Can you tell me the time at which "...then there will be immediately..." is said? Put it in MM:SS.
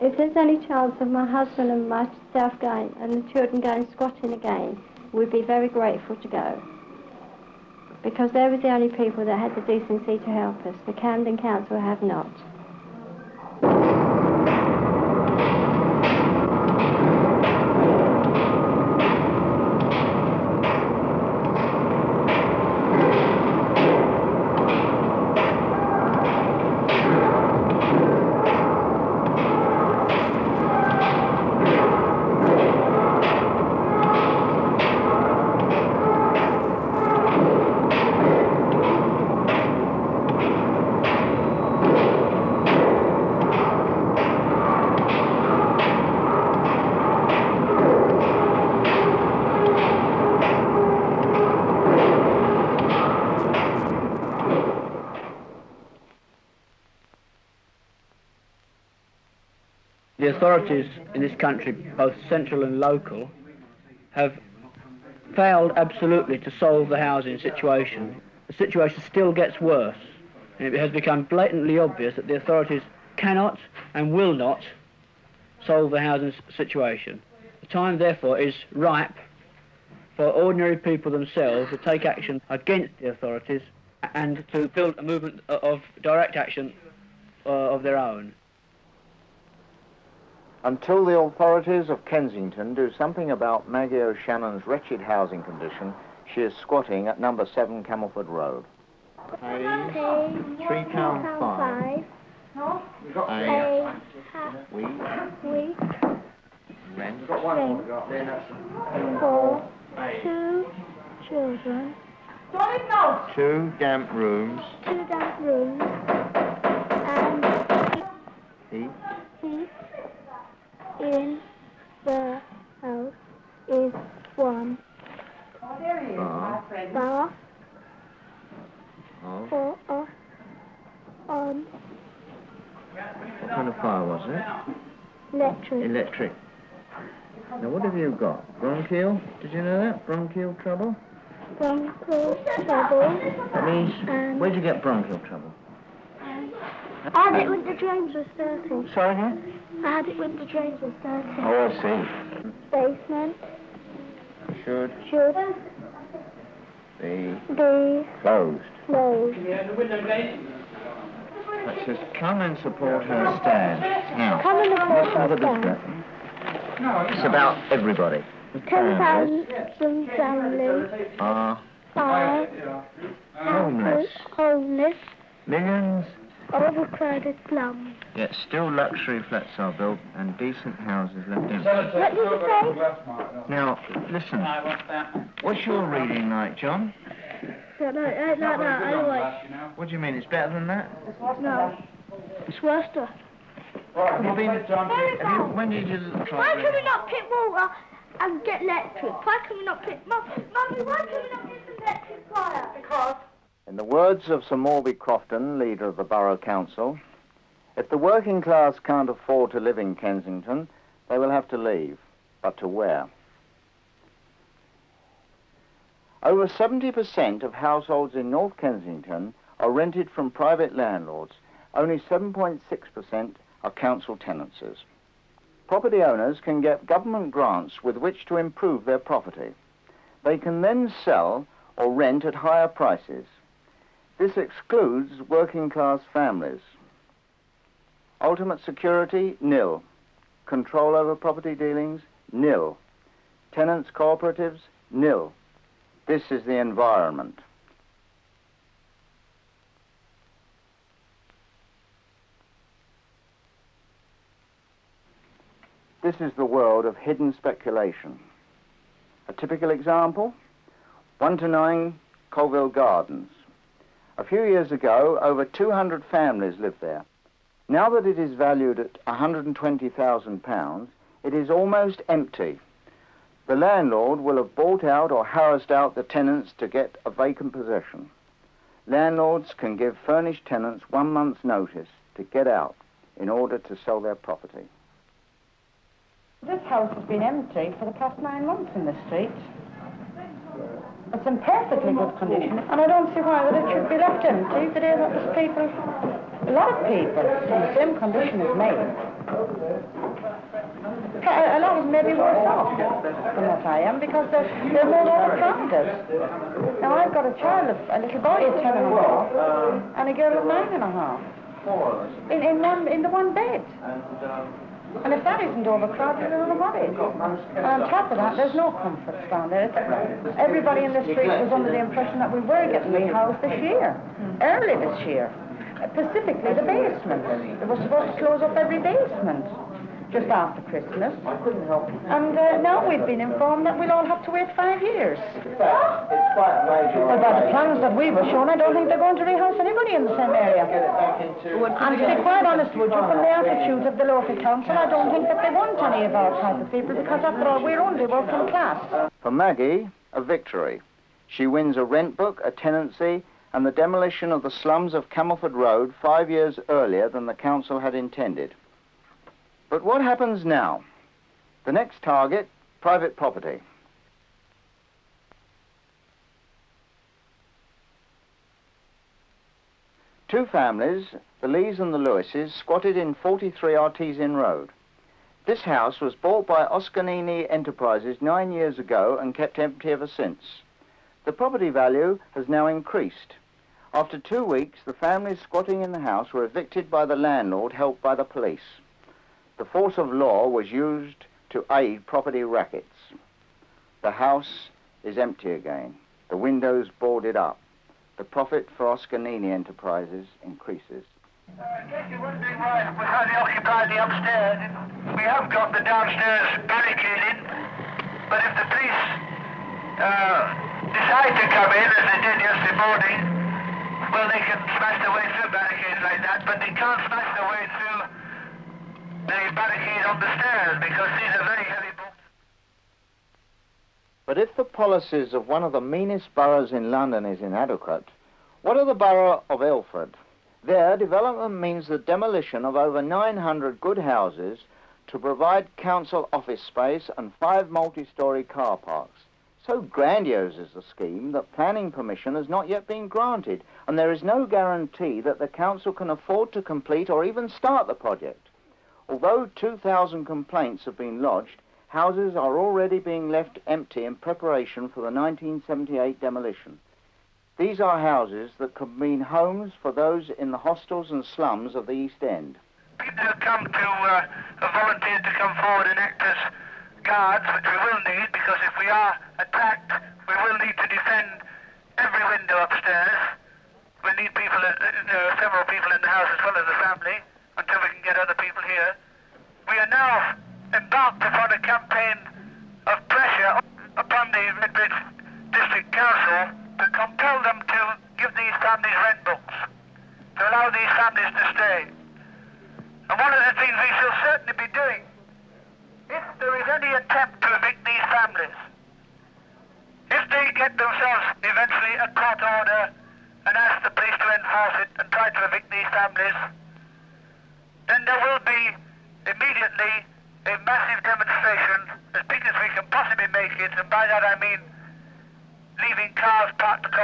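08:27.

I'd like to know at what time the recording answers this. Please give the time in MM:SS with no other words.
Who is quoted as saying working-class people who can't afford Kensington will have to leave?
03:24.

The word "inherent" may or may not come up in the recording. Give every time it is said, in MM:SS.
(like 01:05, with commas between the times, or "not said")
not said.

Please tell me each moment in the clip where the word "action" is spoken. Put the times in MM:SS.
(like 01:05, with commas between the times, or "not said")
01:22, 01:26.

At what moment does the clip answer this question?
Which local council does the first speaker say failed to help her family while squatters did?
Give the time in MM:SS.
00:10.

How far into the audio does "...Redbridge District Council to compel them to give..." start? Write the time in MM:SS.
08:04.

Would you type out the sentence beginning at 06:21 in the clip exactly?
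The property value has now increased.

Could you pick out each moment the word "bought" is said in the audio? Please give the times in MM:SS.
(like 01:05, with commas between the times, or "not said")
04:34, 06:16.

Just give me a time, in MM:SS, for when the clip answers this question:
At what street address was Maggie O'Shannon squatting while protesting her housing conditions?
01:37.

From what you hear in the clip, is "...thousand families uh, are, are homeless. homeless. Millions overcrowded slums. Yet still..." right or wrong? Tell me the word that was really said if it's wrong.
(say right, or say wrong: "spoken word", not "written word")
right.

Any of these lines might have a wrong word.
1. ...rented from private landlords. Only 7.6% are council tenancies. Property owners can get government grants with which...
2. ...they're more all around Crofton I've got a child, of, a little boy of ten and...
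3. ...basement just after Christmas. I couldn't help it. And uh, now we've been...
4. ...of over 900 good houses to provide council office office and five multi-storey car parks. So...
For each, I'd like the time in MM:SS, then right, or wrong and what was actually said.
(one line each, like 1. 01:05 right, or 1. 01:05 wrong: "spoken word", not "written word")
1. 03:39 right
2. 05:04 wrong: "Now", not "Crofton"
3. 05:28 right
4. 07:12 wrong: "space", not "office".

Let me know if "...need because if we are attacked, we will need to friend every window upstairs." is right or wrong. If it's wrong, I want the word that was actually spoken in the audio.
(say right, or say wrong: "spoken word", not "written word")
wrong: "defend", not "friend".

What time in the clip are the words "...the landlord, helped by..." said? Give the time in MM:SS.
06:27.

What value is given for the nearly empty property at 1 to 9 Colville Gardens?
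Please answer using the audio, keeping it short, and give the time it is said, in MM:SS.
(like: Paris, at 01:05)
£120,000, at 04:29.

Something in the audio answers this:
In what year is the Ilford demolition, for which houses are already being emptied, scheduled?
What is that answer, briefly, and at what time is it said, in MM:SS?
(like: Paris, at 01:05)
1978, at 07:35.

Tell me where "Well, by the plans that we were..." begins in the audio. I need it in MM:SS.
05:37.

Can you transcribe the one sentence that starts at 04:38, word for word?
Landlords can give furnished tenants one month's notice to get out in order to sell their property.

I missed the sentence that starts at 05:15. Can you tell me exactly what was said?
And if that isn't overcrowded, I are not know what um, is.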